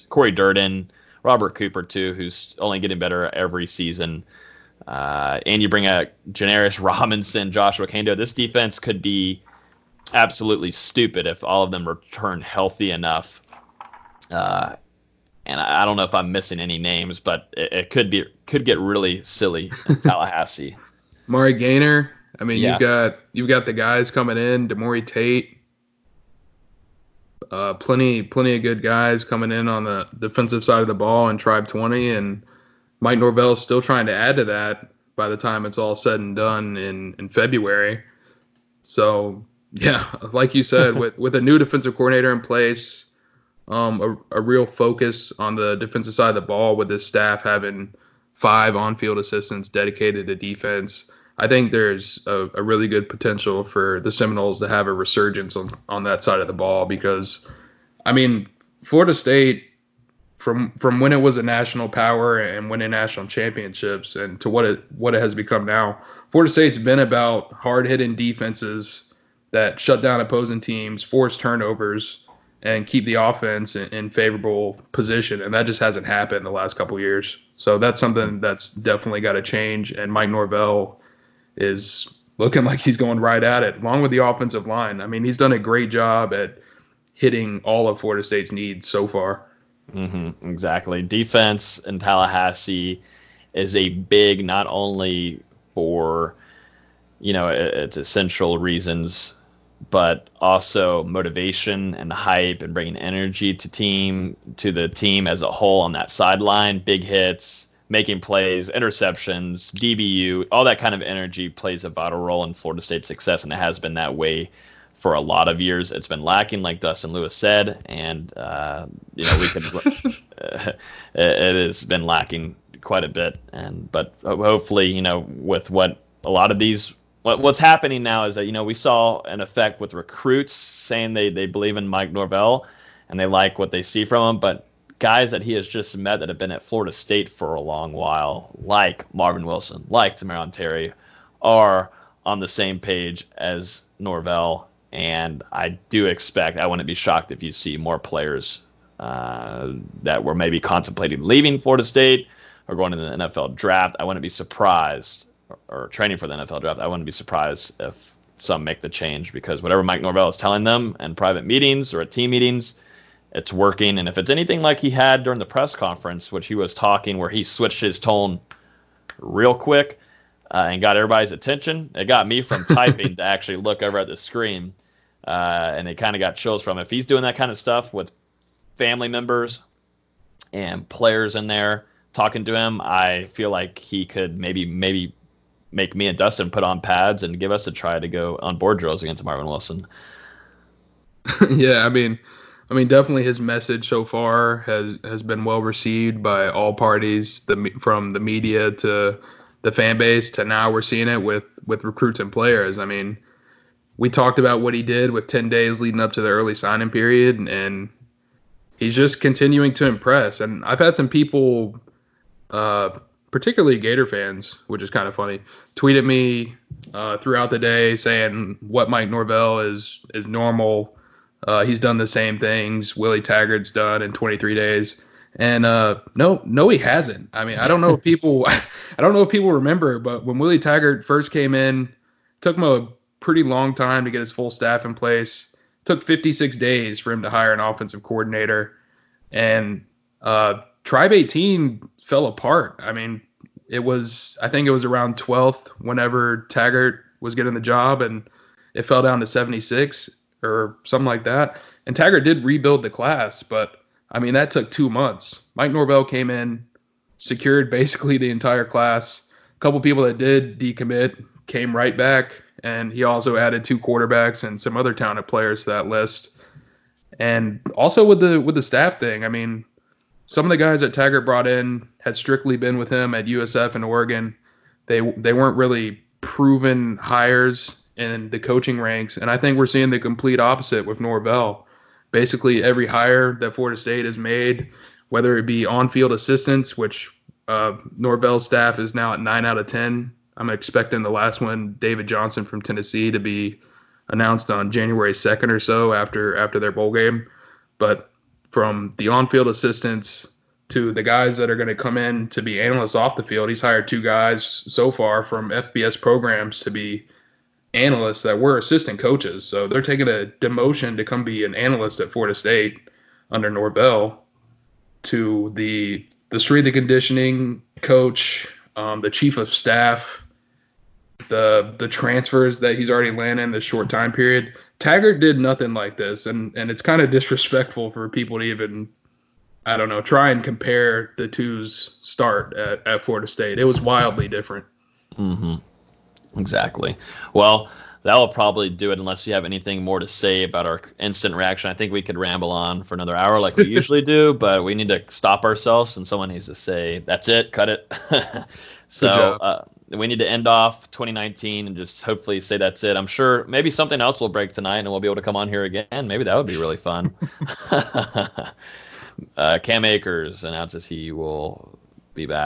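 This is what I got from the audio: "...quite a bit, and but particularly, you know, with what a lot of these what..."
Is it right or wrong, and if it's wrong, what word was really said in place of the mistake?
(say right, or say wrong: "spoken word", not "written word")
wrong: "hopefully", not "particularly".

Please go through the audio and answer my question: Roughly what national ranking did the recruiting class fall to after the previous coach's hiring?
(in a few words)
76.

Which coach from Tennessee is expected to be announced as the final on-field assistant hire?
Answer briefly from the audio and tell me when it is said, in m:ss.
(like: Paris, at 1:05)
David Johnson, at 4:51.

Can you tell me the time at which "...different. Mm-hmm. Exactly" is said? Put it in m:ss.
5:34.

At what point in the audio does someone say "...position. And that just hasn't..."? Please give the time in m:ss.
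1:14.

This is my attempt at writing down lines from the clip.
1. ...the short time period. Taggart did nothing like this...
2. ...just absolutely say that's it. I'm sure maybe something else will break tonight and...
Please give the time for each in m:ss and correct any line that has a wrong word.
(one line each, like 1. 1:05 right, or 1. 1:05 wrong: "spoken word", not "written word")
1. 5:23 right
2. 5:51 wrong: "hopefully", not "absolutely".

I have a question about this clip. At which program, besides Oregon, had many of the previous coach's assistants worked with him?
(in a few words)
USF.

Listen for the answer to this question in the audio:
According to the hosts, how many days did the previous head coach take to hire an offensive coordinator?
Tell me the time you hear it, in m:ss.
3:56.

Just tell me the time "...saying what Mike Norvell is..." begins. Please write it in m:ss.
3:37.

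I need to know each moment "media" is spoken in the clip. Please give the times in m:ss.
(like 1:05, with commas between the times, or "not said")
3:18.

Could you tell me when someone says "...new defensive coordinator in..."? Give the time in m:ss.
0:41.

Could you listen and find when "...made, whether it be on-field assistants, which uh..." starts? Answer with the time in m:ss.
4:44.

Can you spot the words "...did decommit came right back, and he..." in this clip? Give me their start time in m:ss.
4:20.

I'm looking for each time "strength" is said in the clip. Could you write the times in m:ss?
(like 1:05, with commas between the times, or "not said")
5:16.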